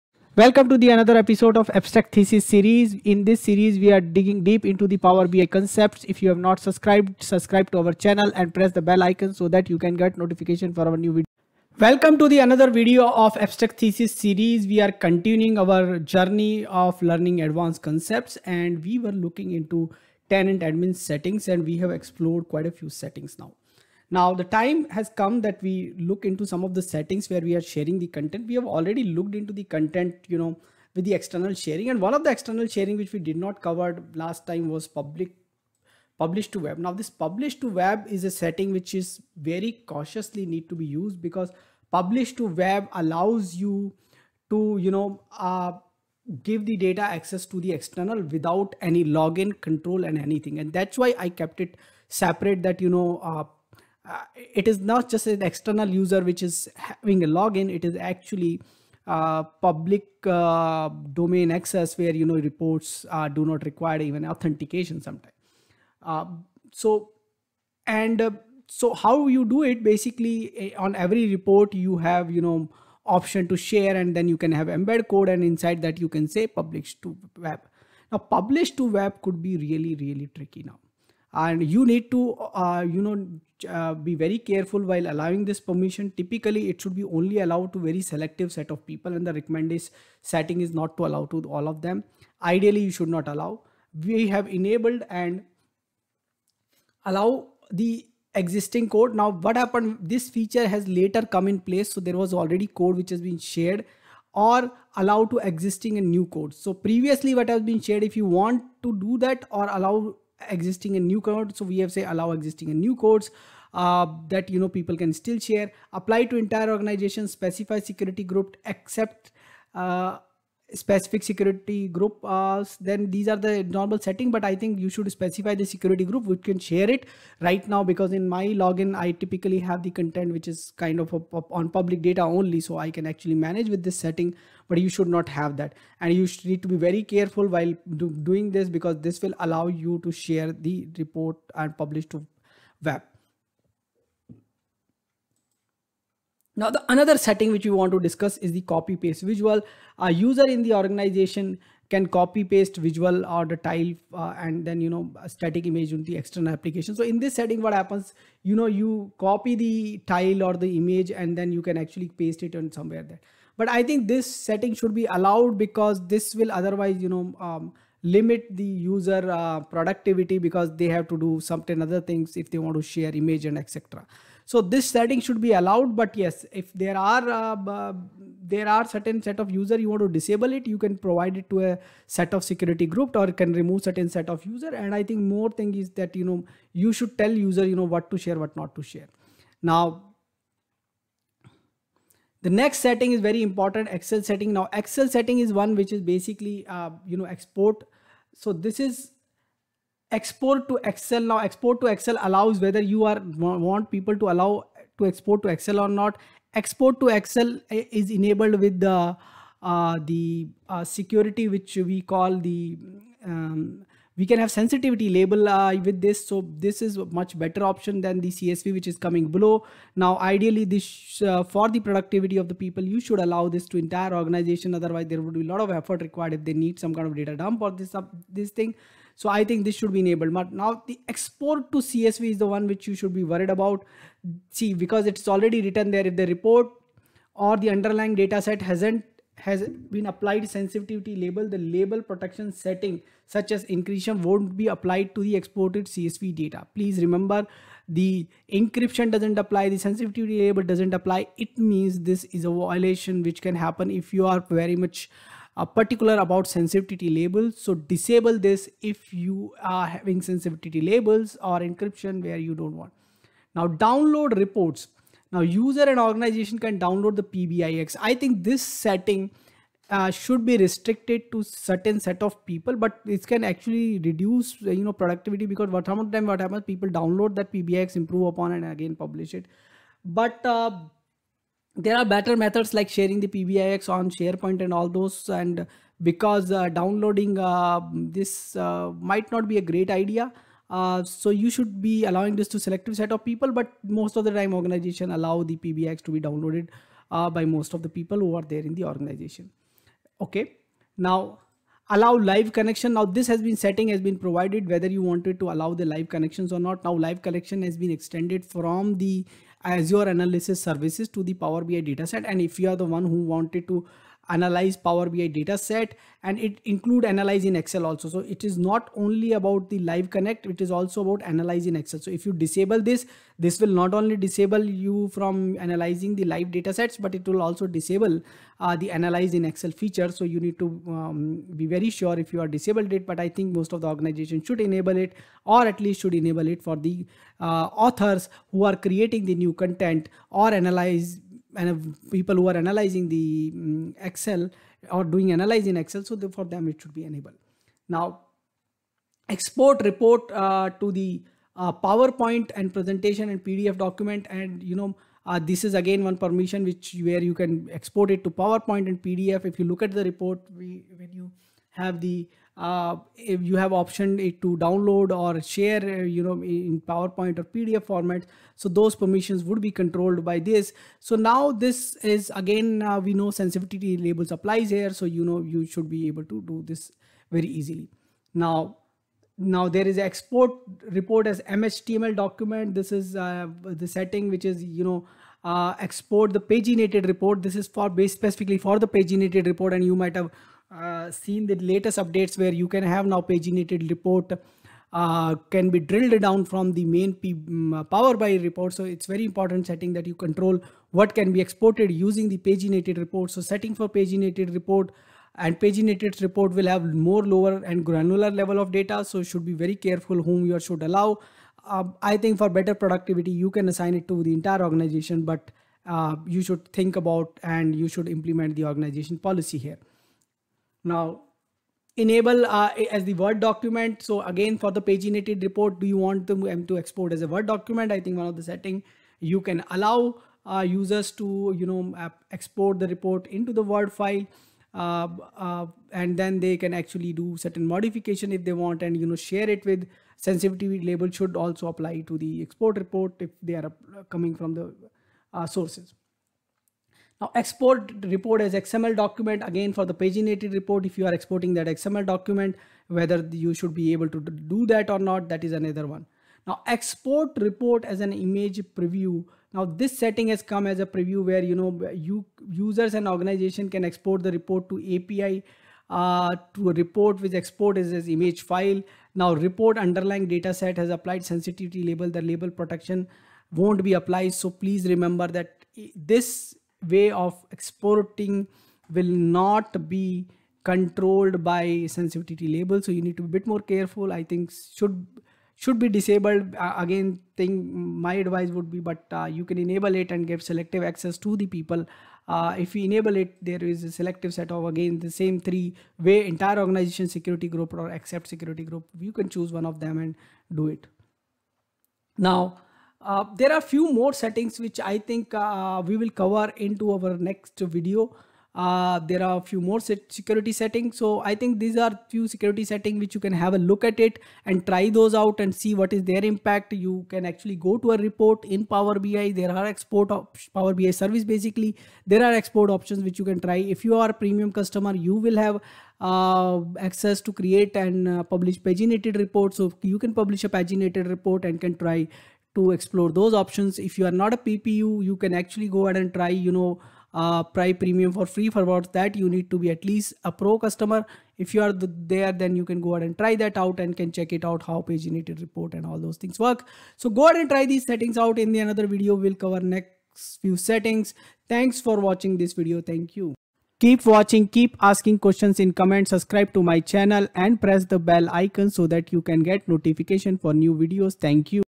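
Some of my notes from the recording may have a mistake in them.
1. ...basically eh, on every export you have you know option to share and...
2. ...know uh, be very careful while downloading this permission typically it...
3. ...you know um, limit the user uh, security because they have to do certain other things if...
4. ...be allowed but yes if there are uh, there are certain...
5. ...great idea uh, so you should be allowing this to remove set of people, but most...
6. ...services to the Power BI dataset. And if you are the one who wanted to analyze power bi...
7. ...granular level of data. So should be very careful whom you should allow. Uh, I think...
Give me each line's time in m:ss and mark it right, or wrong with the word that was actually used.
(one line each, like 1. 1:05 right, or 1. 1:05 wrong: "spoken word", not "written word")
1. 1:09 wrong: "report", not "export"
2. 1:23 wrong: "allowing", not "downloading"
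3. 2:47 wrong: "productivity", not "security"
4. 2:55 right
5. 4:49 wrong: "selective", not "remove"
6. 5:10 right
7. 6:47 right.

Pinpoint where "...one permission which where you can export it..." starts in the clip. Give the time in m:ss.
5:56.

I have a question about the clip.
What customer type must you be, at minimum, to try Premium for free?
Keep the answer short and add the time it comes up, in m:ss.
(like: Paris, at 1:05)
Pro customer, at 9:00.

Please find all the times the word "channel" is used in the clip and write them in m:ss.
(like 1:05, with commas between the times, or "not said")
0:07, 9:16.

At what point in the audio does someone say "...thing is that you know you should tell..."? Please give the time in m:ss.
3:05.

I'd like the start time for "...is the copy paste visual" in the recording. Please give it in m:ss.
2:28.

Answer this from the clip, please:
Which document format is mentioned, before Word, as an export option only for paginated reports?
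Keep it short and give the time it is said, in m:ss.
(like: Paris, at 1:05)
MHTML, at 6:21.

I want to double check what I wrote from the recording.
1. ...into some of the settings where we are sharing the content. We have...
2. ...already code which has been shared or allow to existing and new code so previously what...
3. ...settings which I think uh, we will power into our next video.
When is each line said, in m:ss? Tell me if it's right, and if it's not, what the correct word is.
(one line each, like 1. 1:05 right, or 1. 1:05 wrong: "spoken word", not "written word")
1. 0:26 right
2. 1:42 right
3. 8:24 wrong: "cover", not "power".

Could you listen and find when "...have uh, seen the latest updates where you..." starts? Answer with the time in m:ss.
6:30.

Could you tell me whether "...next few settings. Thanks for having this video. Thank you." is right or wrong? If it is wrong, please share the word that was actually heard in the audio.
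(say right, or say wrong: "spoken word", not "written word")
wrong: "watching", not "having".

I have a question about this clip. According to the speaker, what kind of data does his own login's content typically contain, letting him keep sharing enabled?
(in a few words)
Public data.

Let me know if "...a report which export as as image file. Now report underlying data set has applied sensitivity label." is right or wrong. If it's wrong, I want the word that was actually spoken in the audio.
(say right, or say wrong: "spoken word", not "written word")
right.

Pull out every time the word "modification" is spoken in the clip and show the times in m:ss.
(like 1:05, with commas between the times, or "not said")
7:17.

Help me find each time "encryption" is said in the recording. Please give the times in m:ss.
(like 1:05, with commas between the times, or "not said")
4:03, 4:08, 4:21.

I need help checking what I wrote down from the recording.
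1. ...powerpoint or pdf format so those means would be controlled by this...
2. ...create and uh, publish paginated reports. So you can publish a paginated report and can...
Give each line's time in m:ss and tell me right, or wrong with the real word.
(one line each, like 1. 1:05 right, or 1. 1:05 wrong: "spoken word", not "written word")
1. 6:06 wrong: "permissions", not "means"
2. 8:47 right.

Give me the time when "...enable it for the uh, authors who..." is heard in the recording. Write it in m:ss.
5:36.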